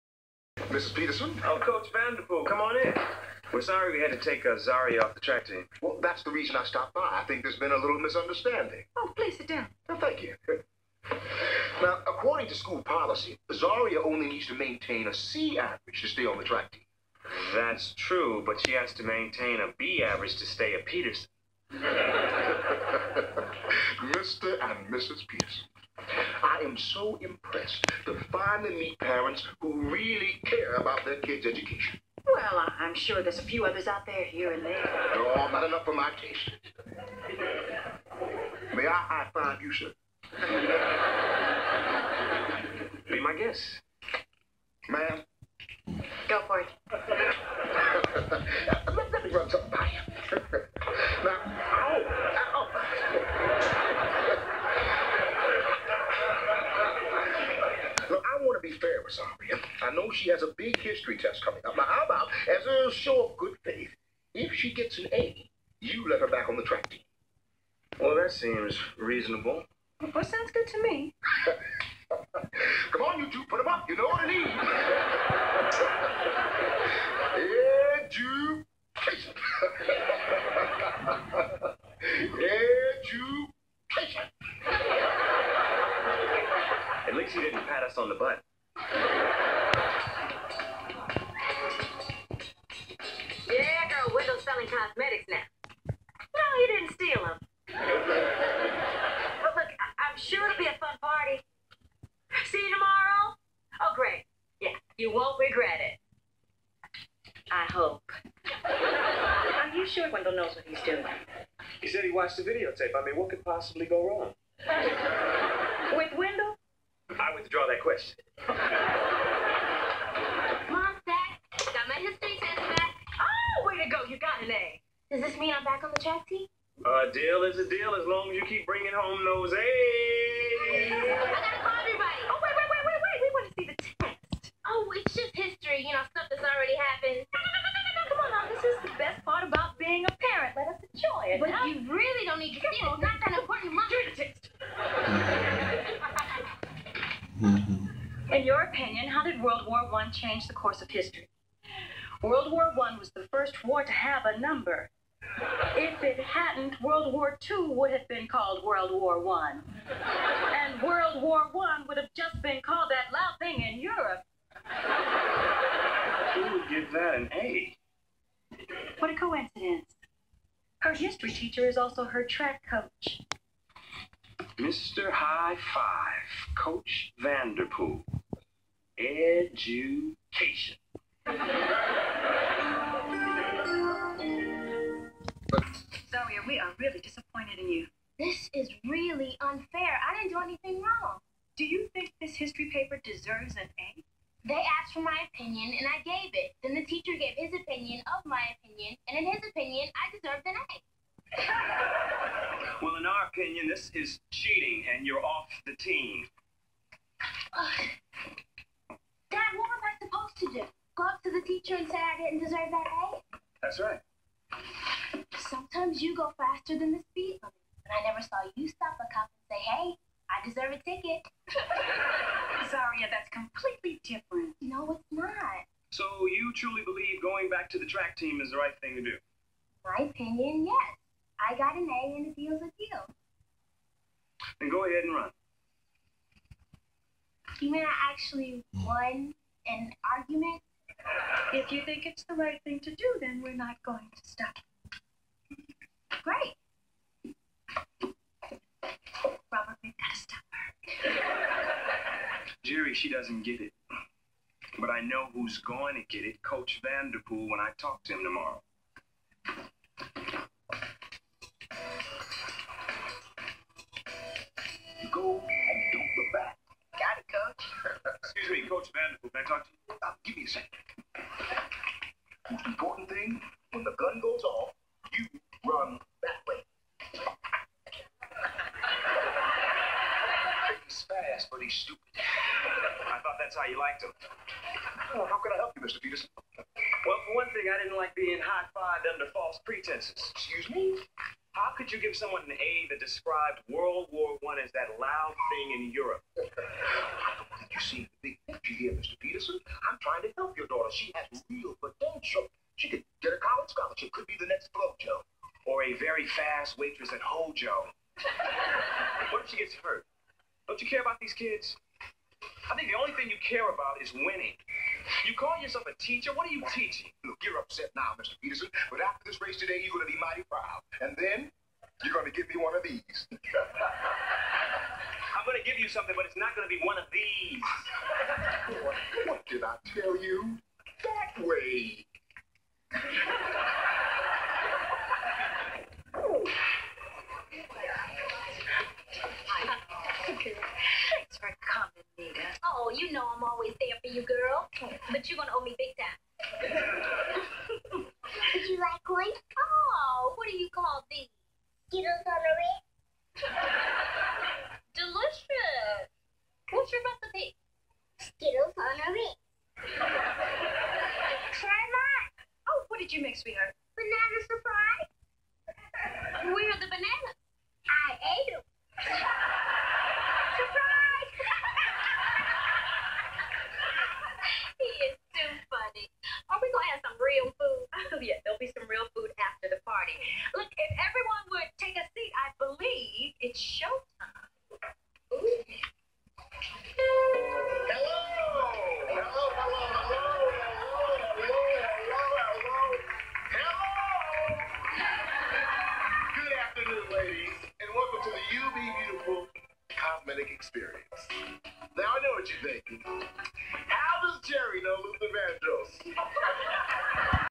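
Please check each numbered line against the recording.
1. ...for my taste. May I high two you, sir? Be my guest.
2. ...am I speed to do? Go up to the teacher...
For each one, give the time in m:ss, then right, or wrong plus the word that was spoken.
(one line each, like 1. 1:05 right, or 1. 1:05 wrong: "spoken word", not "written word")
1. 0:35 wrong: "five", not "two"
2. 3:29 wrong: "supposed", not "speed".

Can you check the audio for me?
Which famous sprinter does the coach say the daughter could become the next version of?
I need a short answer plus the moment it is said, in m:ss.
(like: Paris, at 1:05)
Flojo, at 5:04.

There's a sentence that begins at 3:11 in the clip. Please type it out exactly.
Do you think this history paper deserves an A?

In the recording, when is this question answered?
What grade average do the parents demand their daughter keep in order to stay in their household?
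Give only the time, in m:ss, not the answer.
0:19.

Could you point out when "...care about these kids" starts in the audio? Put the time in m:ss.
5:10.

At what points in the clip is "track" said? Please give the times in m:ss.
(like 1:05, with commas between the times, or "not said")
0:05, 0:16, 1:06, 2:05, 2:52, 3:47.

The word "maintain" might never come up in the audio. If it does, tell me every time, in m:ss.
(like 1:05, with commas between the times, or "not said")
0:14, 0:19.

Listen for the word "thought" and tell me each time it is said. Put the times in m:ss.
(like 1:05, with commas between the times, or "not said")
4:43.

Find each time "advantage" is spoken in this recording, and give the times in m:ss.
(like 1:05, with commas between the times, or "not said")
not said.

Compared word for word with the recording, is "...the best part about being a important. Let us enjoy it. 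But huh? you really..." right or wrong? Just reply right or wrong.
wrong.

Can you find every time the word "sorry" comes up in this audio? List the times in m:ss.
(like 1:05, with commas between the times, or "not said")
0:03.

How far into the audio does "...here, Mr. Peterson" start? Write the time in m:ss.
4:58.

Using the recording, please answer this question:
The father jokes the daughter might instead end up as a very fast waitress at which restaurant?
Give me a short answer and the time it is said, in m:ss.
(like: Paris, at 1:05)
Hojo, at 5:07.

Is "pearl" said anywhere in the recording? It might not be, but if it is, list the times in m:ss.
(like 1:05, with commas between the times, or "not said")
not said.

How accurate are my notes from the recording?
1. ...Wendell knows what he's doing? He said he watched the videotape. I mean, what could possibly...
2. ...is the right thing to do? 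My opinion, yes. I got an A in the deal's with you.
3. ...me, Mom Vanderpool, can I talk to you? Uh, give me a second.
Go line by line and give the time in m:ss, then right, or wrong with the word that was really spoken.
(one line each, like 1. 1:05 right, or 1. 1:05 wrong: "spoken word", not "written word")
1. 1:50 right
2. 3:48 right
3. 4:28 wrong: "Coach", not "Mom".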